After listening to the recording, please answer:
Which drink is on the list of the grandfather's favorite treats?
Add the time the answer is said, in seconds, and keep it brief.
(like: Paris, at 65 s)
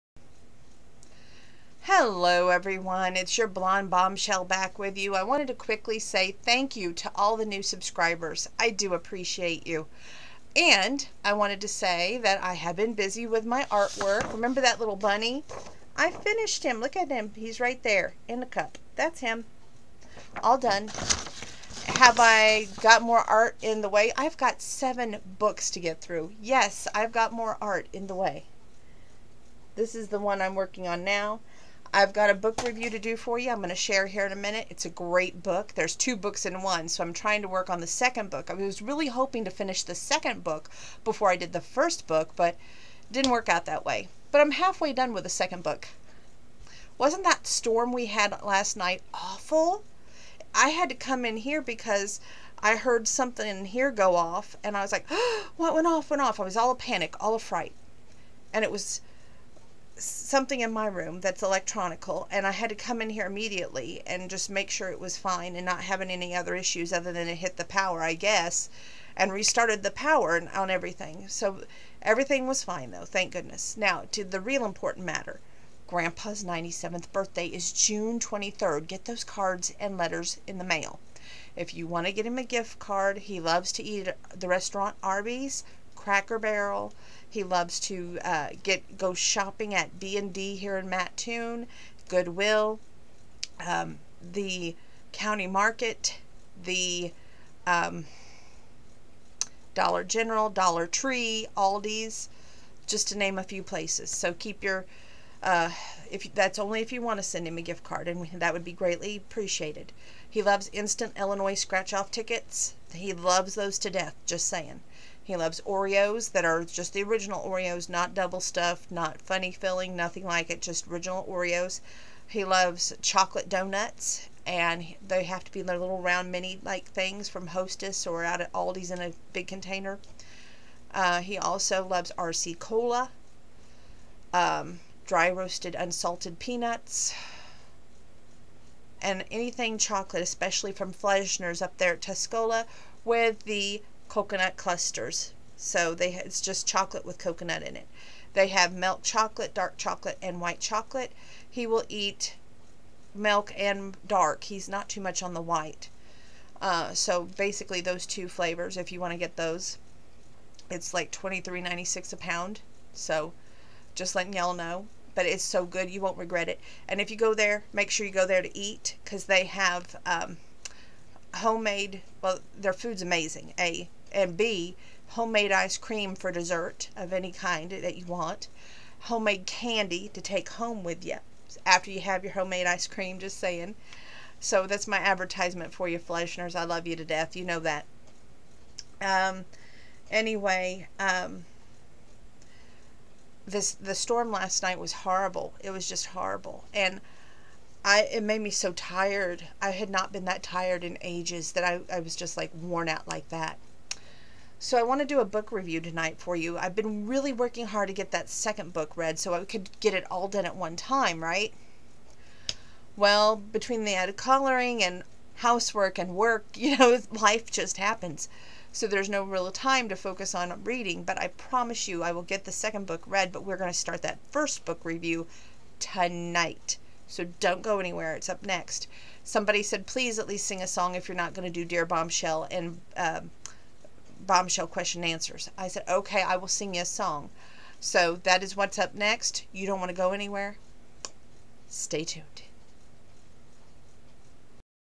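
RC Cola, at 132 s.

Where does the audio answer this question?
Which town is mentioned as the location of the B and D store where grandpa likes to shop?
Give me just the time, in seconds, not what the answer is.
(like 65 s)
90 s.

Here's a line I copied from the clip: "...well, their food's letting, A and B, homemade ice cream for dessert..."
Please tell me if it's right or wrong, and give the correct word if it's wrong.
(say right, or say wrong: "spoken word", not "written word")
wrong: "amazing", not "letting".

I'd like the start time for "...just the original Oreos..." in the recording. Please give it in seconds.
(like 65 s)
116 s.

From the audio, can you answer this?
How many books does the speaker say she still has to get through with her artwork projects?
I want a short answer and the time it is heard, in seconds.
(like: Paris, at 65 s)
7, at 24 s.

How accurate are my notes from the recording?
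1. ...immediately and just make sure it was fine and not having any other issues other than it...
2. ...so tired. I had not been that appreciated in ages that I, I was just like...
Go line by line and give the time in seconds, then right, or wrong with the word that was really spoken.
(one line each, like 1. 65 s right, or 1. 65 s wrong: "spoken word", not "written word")
1. 63 s right
2. 198 s wrong: "tired", not "appreciated".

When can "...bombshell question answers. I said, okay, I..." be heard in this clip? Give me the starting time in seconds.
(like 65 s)
234 s.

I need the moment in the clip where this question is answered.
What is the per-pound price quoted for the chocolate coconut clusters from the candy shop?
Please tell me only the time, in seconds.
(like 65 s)
161 s.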